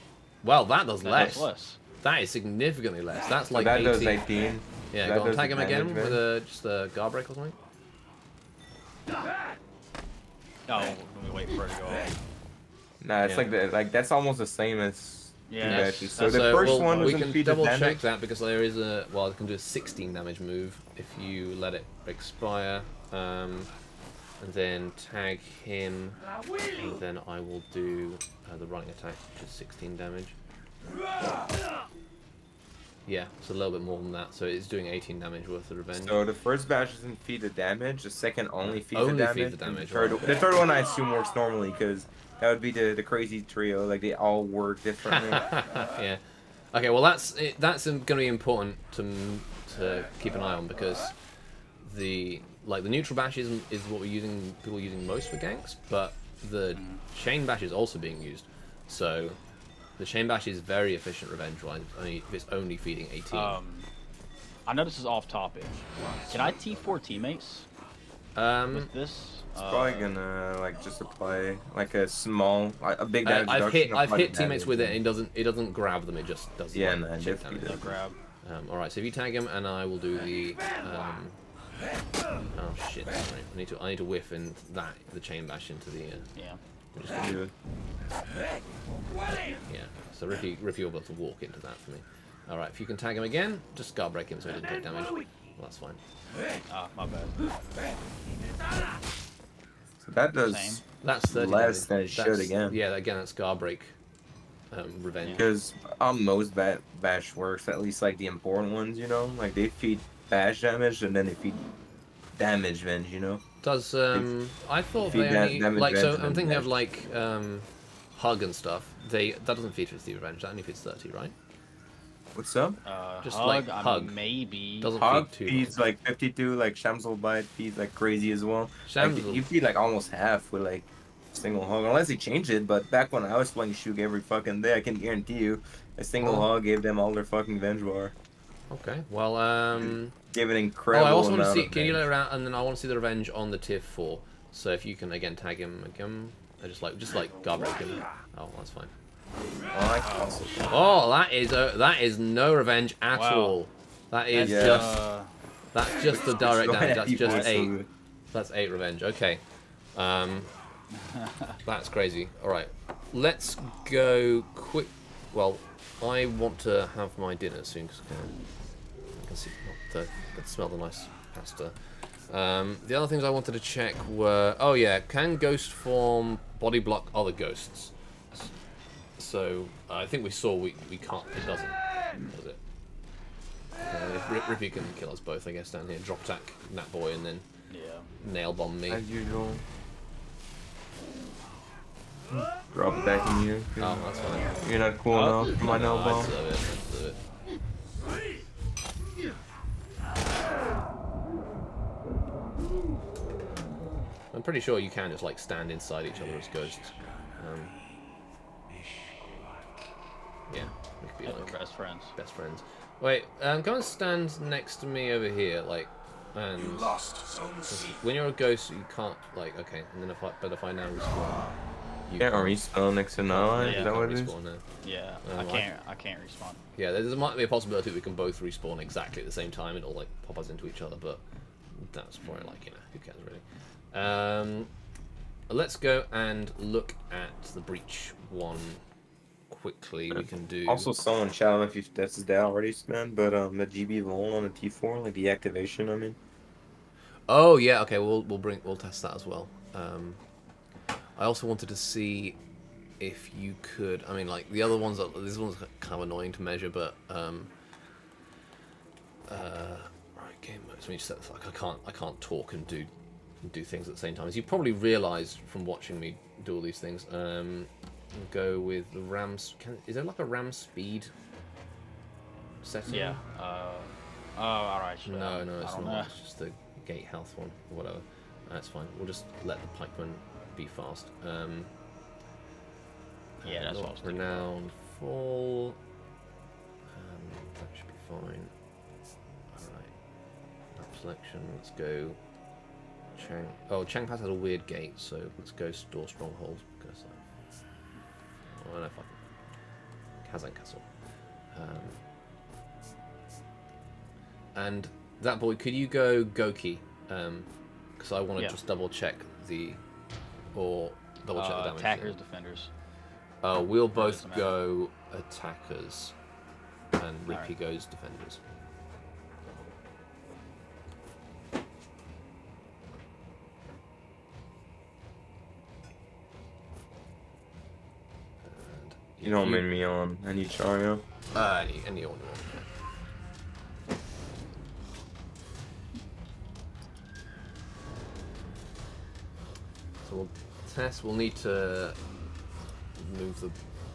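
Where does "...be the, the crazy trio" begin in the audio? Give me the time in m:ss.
0:42.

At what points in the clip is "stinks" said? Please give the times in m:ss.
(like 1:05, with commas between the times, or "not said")
not said.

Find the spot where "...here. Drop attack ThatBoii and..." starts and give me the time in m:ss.
3:05.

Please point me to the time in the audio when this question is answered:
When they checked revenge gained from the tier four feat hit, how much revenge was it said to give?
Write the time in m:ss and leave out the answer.
2:38.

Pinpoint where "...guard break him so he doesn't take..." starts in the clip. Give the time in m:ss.
1:33.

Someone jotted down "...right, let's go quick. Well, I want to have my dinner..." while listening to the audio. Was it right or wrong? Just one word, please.
right.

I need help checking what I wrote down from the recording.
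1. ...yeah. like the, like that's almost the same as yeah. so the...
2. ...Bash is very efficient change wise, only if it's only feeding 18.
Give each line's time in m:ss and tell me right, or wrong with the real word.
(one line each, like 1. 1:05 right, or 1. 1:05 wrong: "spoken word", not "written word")
1. 0:13 right
2. 1:00 wrong: "revenge", not "change".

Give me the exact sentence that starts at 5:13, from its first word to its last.
Uh, we'll both go attackers, and Ricky right.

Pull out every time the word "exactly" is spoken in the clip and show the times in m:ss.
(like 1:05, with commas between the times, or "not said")
3:48.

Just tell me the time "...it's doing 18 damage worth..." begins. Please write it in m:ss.
0:34.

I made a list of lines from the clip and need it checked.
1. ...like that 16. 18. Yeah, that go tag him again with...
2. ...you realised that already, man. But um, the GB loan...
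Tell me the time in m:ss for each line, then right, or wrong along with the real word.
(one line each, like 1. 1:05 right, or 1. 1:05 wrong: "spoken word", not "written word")
1. 0:03 wrong: "18", not "16"
2. 4:01 wrong: "tested", not "realised".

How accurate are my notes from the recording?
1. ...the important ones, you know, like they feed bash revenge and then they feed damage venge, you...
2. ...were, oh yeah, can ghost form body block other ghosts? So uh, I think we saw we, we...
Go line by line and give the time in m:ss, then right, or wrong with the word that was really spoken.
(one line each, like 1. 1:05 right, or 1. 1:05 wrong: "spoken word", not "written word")
1. 1:48 wrong: "damage", not "revenge"
2. 2:54 right.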